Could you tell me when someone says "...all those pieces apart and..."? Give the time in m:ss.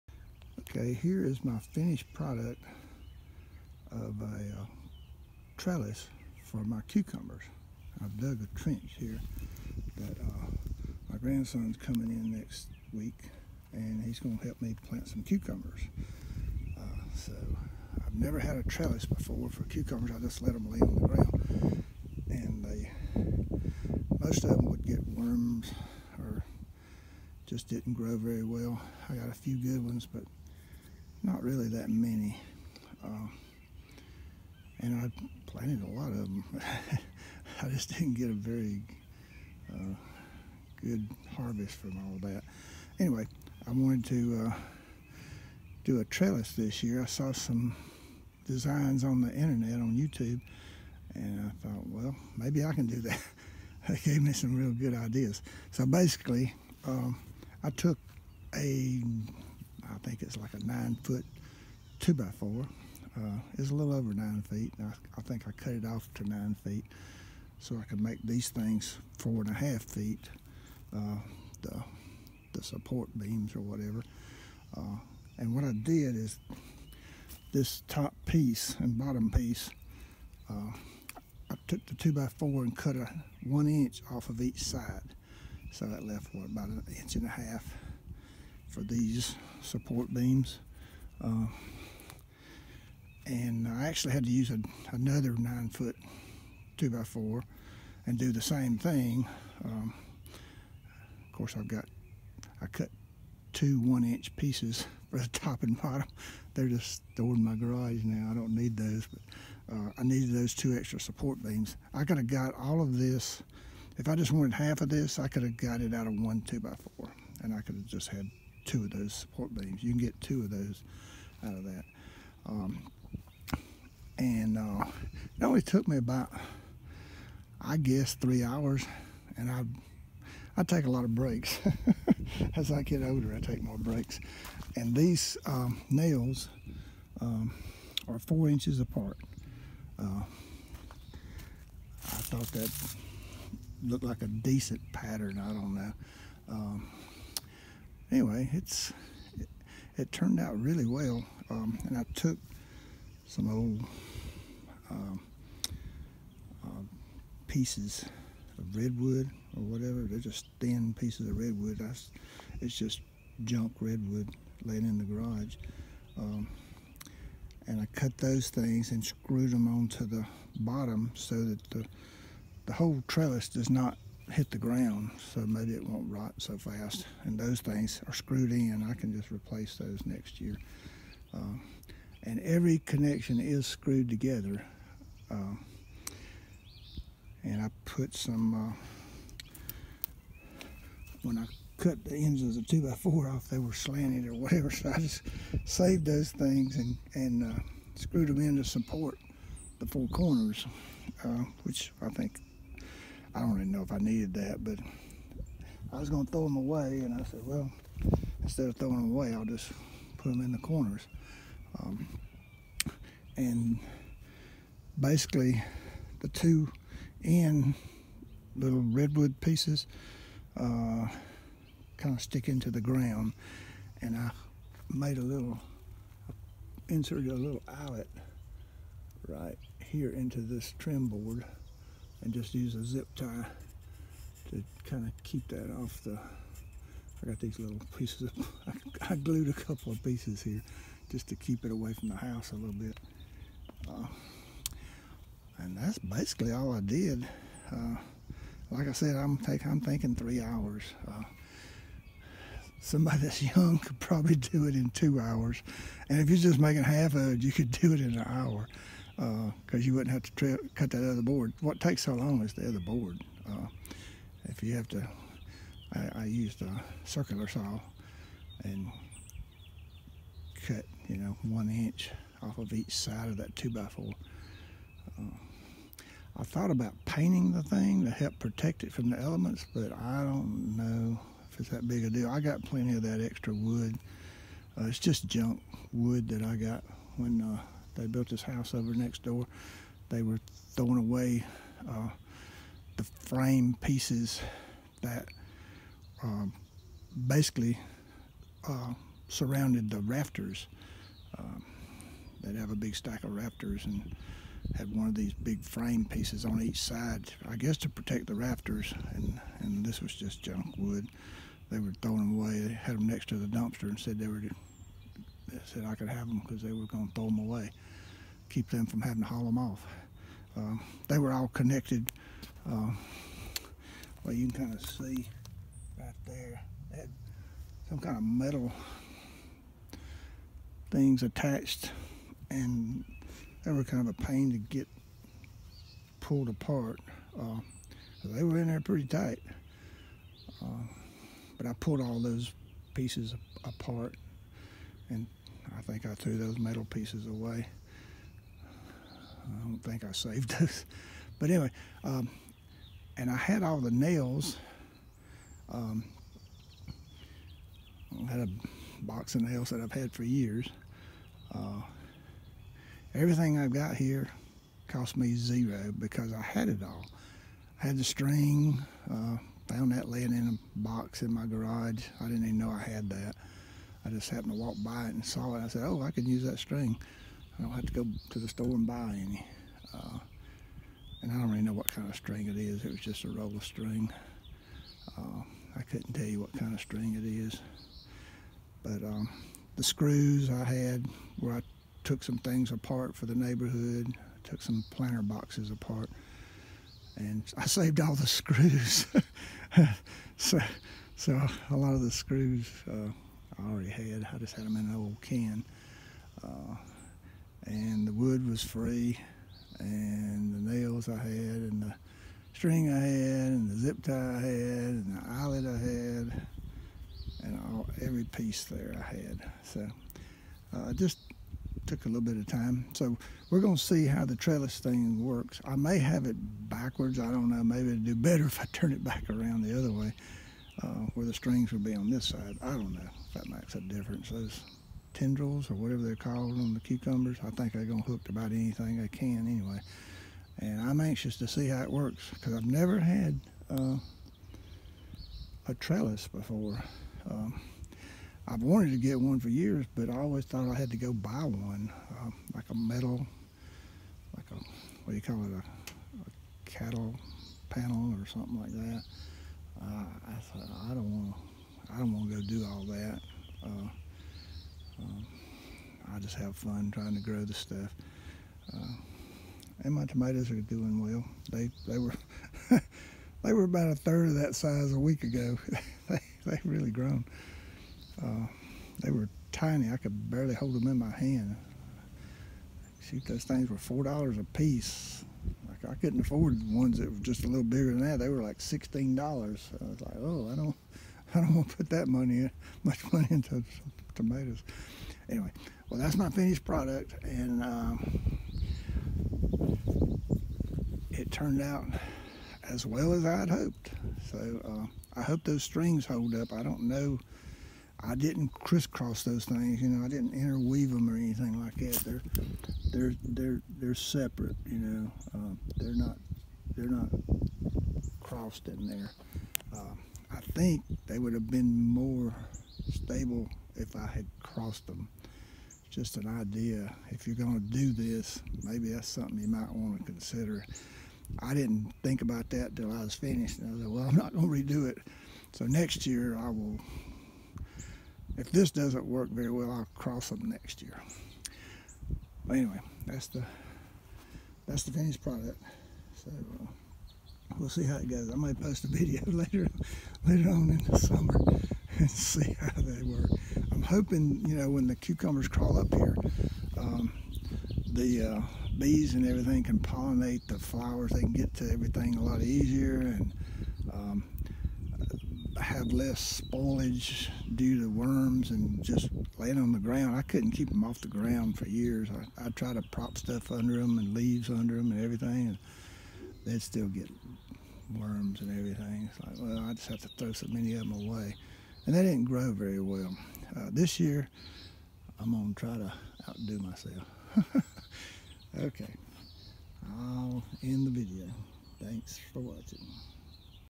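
5:42.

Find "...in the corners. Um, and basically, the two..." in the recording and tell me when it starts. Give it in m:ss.
3:30.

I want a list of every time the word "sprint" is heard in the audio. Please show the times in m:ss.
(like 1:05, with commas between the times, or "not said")
not said.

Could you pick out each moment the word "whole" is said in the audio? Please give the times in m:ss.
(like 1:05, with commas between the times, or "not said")
2:52.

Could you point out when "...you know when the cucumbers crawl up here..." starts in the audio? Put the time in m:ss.
9:14.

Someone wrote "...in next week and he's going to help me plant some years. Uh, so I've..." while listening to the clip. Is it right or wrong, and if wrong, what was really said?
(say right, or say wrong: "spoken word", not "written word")
wrong: "cucumbers", not "years".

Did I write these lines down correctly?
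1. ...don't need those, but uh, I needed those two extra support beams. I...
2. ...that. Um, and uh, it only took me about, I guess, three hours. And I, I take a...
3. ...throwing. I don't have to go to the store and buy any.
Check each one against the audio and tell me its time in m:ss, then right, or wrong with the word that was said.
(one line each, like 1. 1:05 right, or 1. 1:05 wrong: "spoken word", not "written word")
1. 1:48 right
2. 2:01 right
3. 6:16 wrong: "string", not "throwing".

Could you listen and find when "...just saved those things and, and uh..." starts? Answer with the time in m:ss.
3:14.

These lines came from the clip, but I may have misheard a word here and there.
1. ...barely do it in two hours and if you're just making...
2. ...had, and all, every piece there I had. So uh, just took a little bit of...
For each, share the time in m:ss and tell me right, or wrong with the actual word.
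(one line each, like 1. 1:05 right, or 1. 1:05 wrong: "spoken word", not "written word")
1. 4:13 wrong: "probably", not "barely"
2. 6:55 right.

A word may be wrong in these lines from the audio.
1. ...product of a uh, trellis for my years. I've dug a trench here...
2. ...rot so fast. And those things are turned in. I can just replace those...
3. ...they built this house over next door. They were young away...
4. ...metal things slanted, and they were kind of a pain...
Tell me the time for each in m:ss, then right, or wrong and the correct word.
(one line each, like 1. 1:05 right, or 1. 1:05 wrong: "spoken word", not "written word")
1. 0:02 wrong: "cucumbers", not "years"
2. 2:56 wrong: "screwed", not "turned"
3. 4:47 wrong: "throwing", not "young"
4. 5:28 wrong: "attached", not "slanted".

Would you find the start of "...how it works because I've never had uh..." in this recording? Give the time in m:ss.
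7:21.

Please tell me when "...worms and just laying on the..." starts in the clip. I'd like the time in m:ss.
9:27.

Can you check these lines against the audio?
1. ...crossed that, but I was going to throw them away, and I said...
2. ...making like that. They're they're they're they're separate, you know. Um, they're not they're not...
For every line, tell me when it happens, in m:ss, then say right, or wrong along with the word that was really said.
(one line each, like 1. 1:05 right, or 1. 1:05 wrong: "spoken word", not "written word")
1. 3:23 wrong: "needed", not "crossed"
2. 8:31 wrong: "anything", not "making".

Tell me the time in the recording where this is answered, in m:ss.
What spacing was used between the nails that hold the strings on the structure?
2:18.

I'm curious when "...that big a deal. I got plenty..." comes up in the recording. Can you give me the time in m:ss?
4:41.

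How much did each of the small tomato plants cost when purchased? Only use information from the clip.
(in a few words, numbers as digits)
$4.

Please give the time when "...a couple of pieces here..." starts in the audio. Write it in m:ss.
3:59.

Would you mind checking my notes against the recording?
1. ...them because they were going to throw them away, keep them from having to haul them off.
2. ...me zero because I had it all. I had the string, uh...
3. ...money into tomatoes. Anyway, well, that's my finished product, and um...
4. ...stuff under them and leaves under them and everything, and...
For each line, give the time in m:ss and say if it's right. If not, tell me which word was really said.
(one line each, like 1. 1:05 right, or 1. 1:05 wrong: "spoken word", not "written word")
1. 5:16 right
2. 6:05 right
3. 8:13 right
4. 9:33 right.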